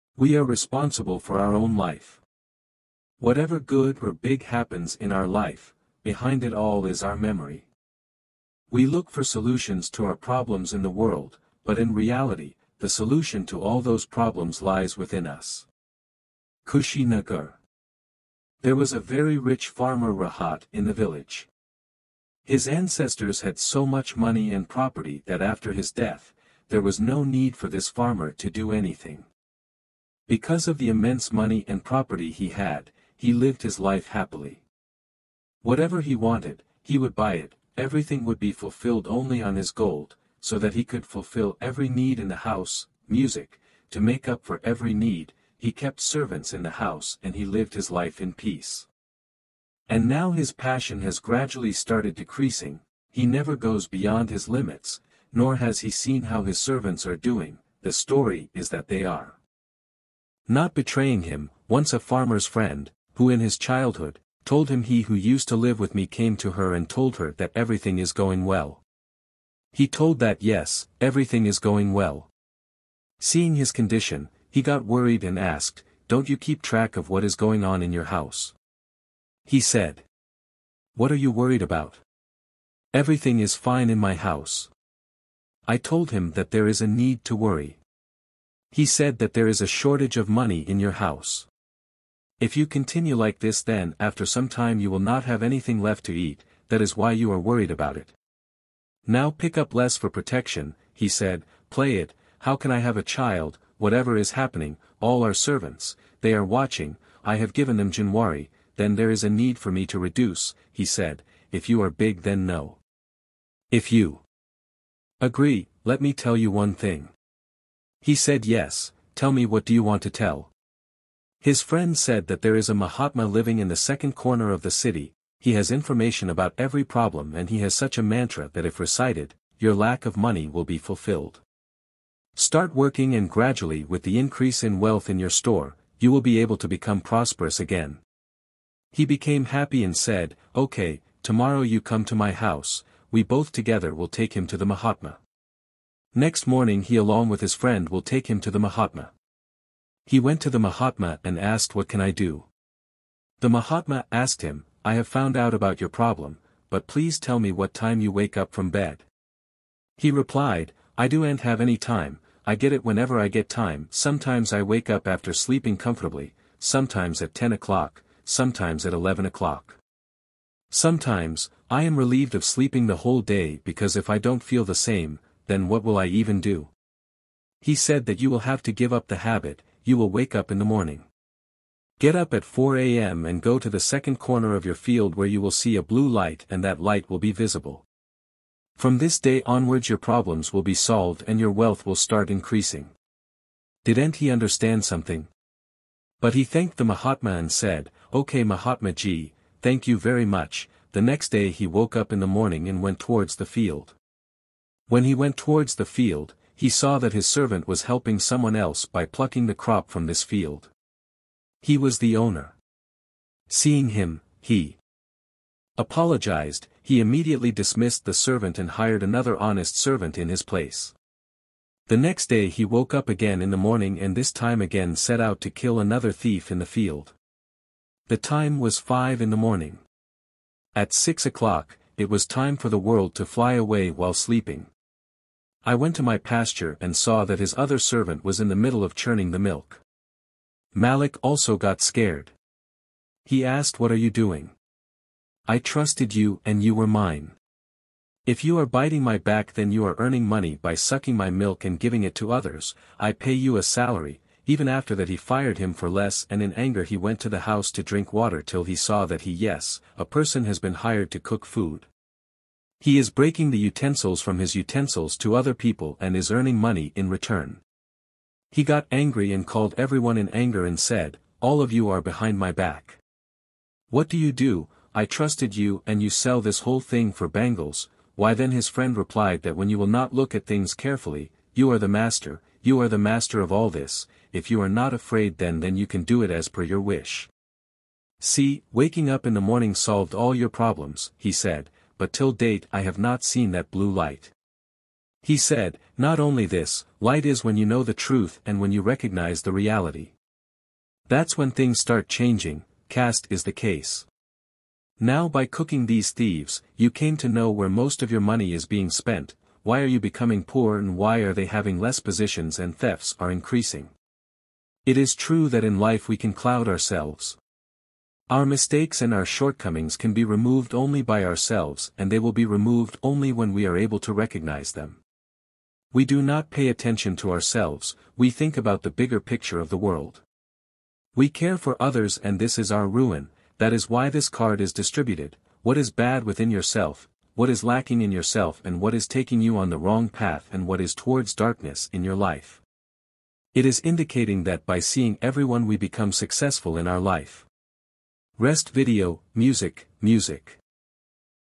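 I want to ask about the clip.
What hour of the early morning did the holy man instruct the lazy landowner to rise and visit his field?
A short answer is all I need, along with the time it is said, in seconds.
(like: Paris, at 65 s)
4 a.m., at 182 s.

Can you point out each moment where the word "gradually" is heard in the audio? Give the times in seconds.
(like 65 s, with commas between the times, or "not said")
51 s, 133 s.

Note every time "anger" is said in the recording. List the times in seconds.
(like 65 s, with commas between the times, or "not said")
256 s, 270 s.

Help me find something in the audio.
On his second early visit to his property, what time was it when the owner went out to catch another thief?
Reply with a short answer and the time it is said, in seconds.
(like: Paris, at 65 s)
5 in the morning, at 228 s.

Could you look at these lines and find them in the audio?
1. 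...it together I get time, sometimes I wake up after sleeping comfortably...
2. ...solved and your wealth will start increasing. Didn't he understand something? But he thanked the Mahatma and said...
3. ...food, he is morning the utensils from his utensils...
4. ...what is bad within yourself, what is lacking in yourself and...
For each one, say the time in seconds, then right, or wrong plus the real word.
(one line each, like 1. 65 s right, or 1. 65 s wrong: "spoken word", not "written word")
1. 162 s wrong: "whenever", not "together"
2. 190 s right
3. 261 s wrong: "breaking", not "morning"
4. 335 s right.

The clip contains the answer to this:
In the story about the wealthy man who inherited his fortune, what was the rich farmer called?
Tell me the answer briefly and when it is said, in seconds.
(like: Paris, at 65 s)
Rahat, at 20 s.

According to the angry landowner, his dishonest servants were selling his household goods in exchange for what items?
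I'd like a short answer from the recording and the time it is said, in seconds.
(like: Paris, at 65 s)
Bangles, at 277 s.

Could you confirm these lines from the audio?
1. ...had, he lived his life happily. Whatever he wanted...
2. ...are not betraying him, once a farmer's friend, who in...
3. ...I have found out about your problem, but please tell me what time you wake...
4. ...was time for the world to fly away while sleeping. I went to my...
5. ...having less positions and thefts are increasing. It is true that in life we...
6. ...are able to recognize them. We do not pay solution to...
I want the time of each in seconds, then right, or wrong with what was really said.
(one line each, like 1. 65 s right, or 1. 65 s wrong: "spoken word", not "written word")
1. 32 s right
2. 59 s right
3. 154 s right
4. 232 s right
5. 311 s right
6. 323 s wrong: "attention", not "solution".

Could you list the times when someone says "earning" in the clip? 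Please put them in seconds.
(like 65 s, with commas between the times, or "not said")
249 s, 266 s.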